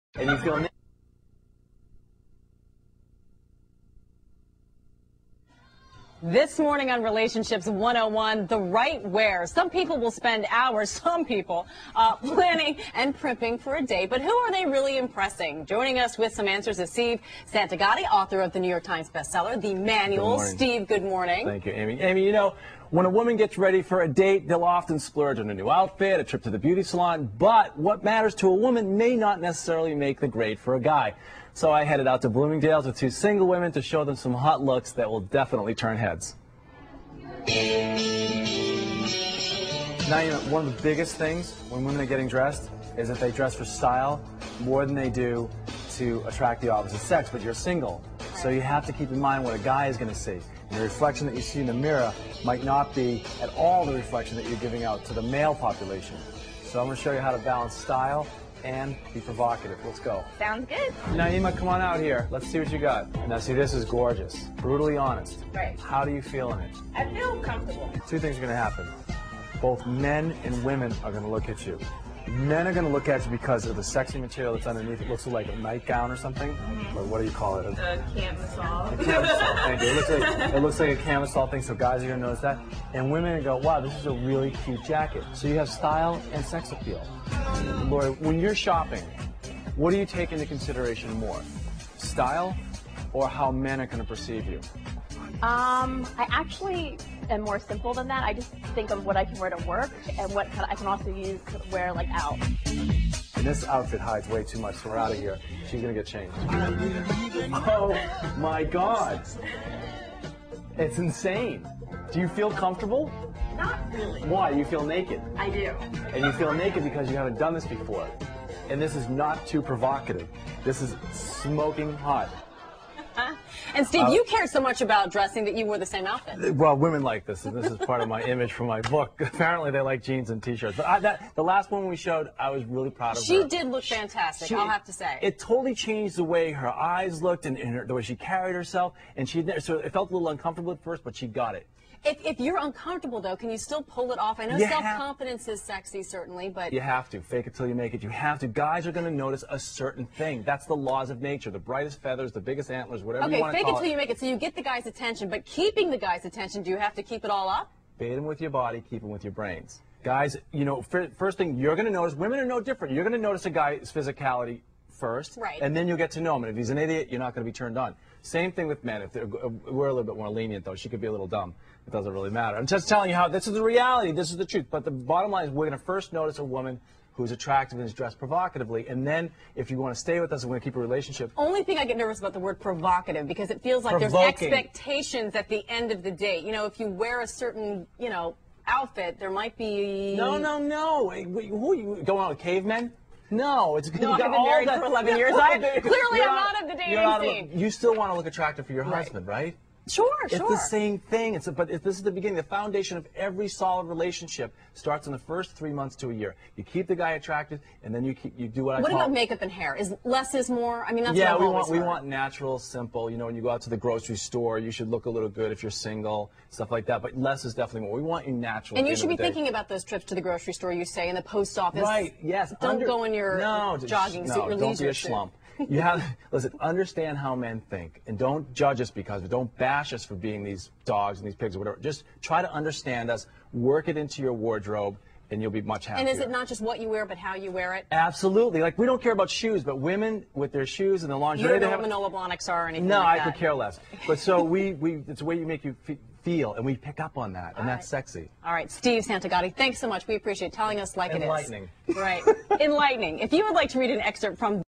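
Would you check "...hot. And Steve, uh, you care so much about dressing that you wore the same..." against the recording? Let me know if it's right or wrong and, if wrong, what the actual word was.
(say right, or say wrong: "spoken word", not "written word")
right.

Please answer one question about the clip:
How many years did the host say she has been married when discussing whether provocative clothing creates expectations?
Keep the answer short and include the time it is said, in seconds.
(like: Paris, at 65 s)
11, at 194 s.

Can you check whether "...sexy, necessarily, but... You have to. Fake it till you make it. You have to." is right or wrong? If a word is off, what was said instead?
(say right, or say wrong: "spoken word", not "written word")
wrong: "certainly", not "necessarily".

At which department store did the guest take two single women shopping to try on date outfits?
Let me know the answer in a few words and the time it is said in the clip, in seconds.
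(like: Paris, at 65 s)
Bloomingdale's, at 32 s.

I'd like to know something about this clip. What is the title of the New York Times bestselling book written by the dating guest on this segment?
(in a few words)
The Manual.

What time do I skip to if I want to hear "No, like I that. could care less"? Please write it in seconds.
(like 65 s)
242 s.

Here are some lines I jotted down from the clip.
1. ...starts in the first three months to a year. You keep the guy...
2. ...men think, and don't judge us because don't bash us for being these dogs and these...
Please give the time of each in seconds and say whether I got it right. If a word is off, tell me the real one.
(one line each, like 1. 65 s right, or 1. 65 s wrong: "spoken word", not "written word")
1. 204 s right
2. 227 s right.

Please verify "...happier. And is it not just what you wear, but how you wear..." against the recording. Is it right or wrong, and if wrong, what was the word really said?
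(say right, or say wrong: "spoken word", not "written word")
right.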